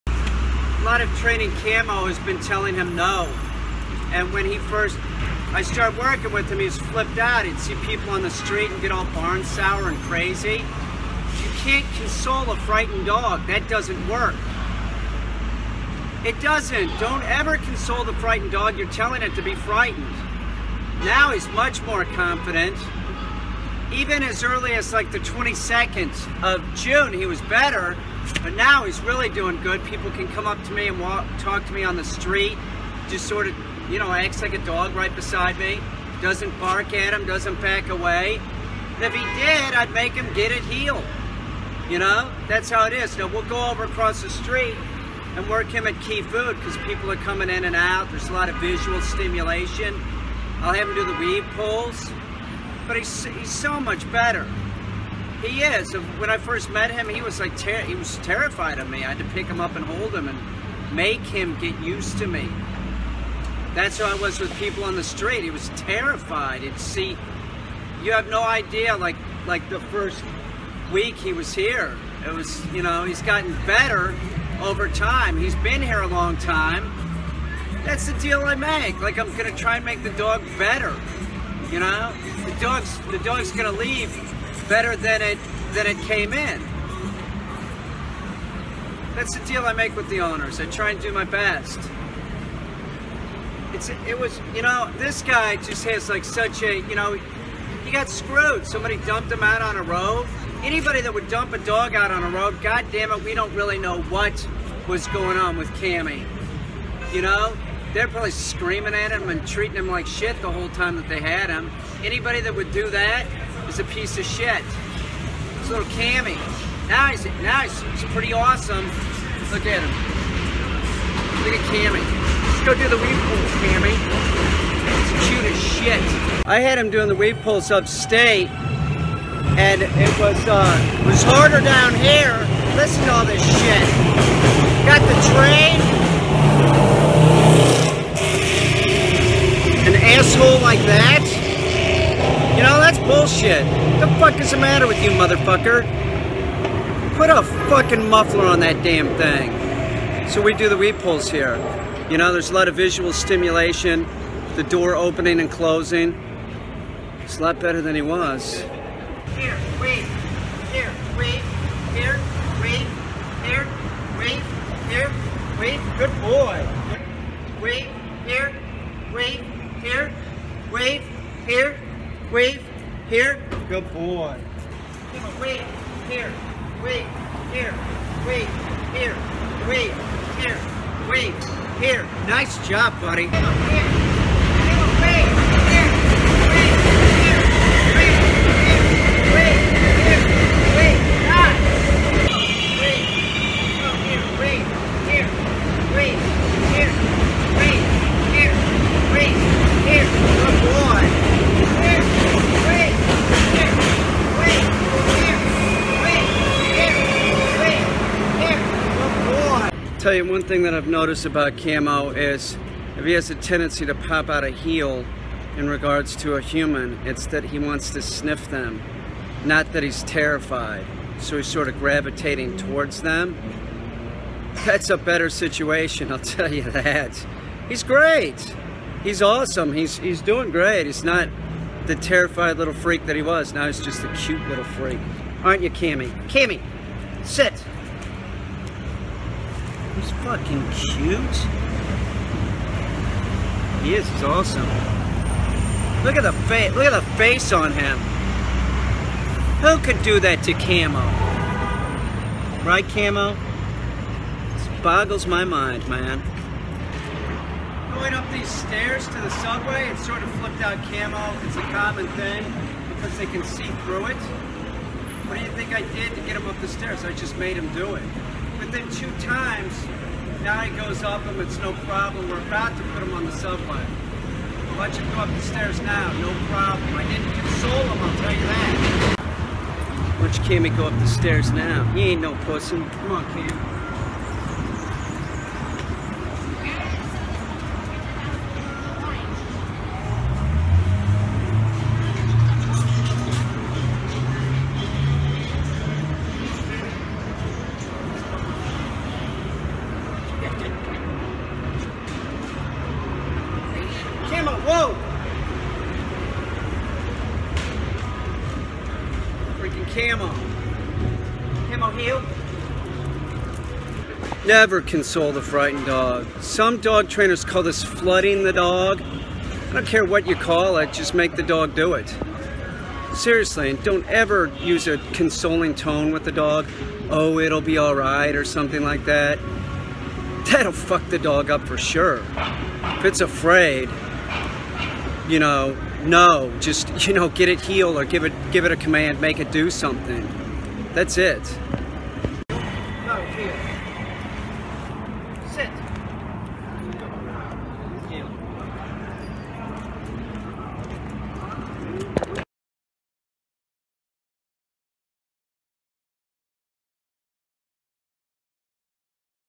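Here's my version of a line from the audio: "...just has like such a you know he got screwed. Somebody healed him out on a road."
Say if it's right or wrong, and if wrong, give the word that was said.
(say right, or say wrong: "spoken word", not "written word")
wrong: "dumped", not "healed".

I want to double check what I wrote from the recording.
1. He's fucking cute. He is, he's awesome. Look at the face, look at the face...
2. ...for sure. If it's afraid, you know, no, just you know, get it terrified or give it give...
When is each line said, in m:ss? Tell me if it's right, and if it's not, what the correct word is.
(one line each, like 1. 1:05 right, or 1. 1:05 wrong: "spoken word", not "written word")
1. 4:00 right
2. 5:31 wrong: "healed", not "terrified".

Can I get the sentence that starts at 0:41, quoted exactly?
You know, that's how it is.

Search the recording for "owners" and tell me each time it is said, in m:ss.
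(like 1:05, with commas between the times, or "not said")
1:30.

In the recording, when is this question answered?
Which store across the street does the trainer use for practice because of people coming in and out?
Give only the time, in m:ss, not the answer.
0:46.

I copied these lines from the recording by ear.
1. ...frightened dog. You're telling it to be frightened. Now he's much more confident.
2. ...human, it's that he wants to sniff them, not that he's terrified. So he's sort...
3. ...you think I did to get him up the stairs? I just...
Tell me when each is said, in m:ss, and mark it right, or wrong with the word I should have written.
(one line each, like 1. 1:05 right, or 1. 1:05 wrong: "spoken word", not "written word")
1. 0:18 right
2. 3:36 right
3. 4:25 right.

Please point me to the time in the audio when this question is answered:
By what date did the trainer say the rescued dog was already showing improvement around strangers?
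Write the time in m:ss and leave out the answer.
0:25.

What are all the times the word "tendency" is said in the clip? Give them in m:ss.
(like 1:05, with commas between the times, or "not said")
3:33.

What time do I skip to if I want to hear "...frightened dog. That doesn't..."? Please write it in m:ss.
0:12.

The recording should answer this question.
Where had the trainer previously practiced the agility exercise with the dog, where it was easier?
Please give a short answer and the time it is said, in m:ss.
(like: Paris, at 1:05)
Upstate, at 2:07.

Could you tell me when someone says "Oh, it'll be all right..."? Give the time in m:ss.
5:27.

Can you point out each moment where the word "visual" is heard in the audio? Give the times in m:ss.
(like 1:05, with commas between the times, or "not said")
0:48, 2:32.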